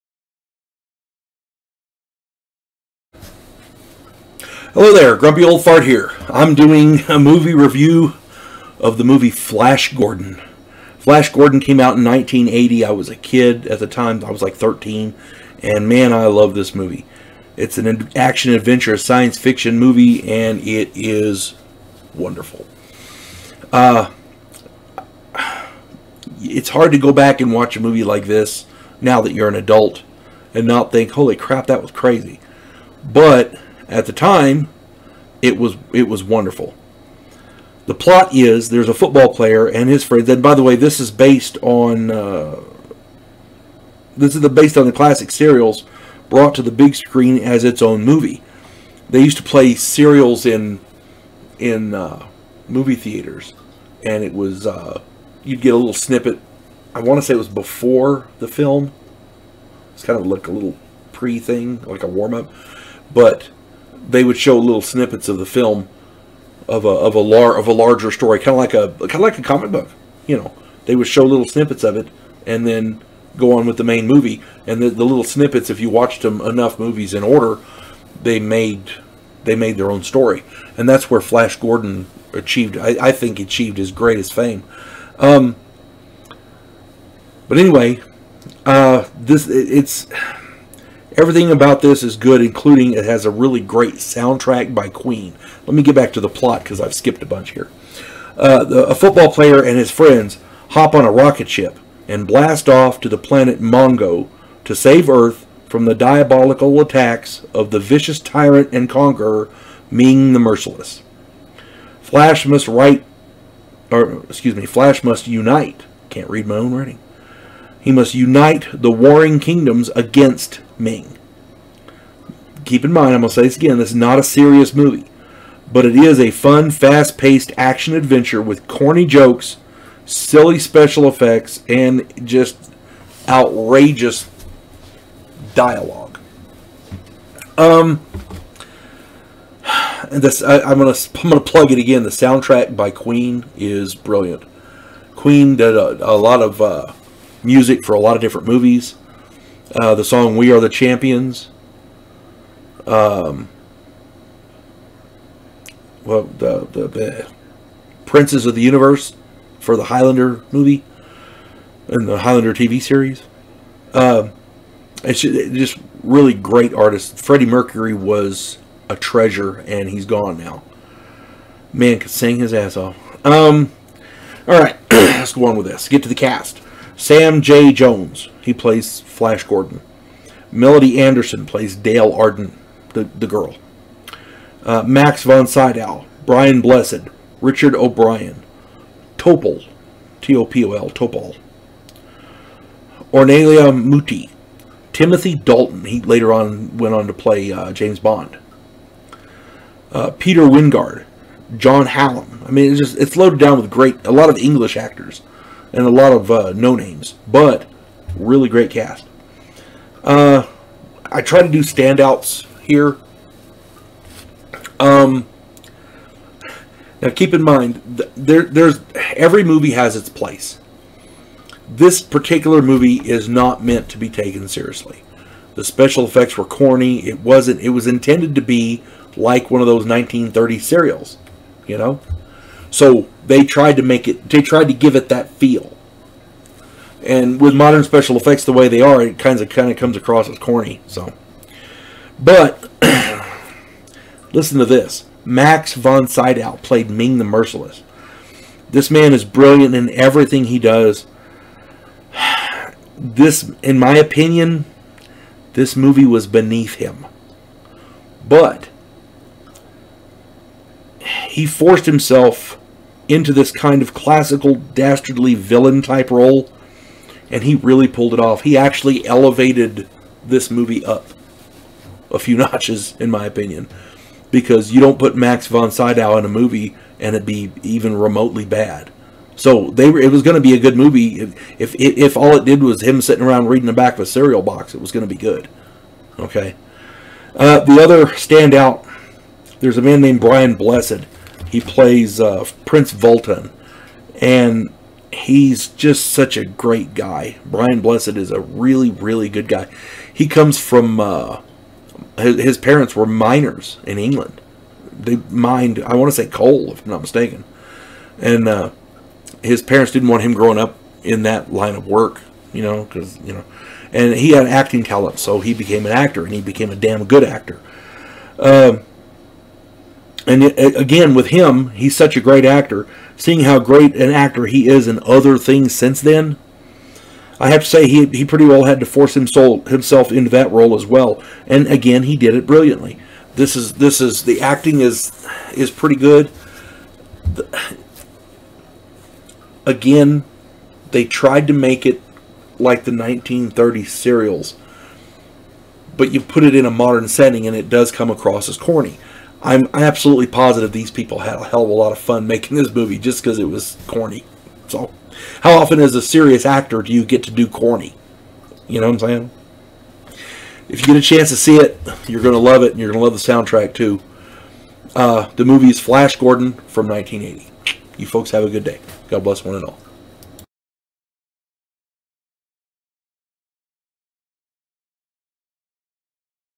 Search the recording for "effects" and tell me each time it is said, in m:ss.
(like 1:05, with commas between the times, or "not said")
2:11, 3:46, 3:58.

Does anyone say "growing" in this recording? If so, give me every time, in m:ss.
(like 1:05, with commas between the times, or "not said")
5:10.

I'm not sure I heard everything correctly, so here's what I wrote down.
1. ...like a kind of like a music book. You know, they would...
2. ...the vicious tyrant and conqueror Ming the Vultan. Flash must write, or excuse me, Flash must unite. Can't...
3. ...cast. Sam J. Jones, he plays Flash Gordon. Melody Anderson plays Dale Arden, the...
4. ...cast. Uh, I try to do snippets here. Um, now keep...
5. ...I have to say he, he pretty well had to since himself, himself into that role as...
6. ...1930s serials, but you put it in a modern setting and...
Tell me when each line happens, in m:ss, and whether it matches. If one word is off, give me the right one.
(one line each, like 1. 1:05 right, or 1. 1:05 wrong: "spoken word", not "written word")
1. 1:08 wrong: "comic", not "music"
2. 1:47 wrong: "Merciless", not "Vultan"
3. 2:56 right
4. 3:28 wrong: "standouts", not "snippets"
5. 5:27 wrong: "force", not "since"
6. 5:42 right.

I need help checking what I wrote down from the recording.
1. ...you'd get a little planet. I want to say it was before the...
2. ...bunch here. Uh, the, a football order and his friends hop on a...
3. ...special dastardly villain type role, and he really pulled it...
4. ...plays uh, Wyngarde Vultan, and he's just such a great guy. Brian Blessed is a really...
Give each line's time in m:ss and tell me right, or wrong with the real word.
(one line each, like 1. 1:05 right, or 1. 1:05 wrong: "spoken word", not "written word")
1. 0:55 wrong: "snippet", not "planet"
2. 1:37 wrong: "player", not "order"
3. 4:23 wrong: "classical", not "special"
4. 4:51 wrong: "Prince", not "Wyngarde".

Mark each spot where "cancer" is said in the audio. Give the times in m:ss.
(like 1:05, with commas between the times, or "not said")
not said.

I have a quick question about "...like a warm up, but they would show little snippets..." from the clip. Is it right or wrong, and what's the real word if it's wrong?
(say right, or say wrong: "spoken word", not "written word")
right.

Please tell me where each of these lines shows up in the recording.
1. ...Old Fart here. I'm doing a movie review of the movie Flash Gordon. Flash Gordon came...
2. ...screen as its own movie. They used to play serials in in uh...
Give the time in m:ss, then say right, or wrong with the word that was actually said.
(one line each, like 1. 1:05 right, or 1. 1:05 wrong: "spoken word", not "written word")
1. 0:05 right
2. 0:46 right.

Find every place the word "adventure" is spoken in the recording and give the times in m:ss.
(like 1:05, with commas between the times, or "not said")
0:18, 2:07.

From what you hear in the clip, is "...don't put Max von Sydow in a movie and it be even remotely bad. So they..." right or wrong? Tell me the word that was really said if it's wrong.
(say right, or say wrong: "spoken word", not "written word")
right.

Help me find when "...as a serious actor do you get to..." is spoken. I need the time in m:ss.
5:55.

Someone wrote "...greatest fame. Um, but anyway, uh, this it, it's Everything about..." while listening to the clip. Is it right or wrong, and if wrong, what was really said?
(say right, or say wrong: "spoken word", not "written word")
right.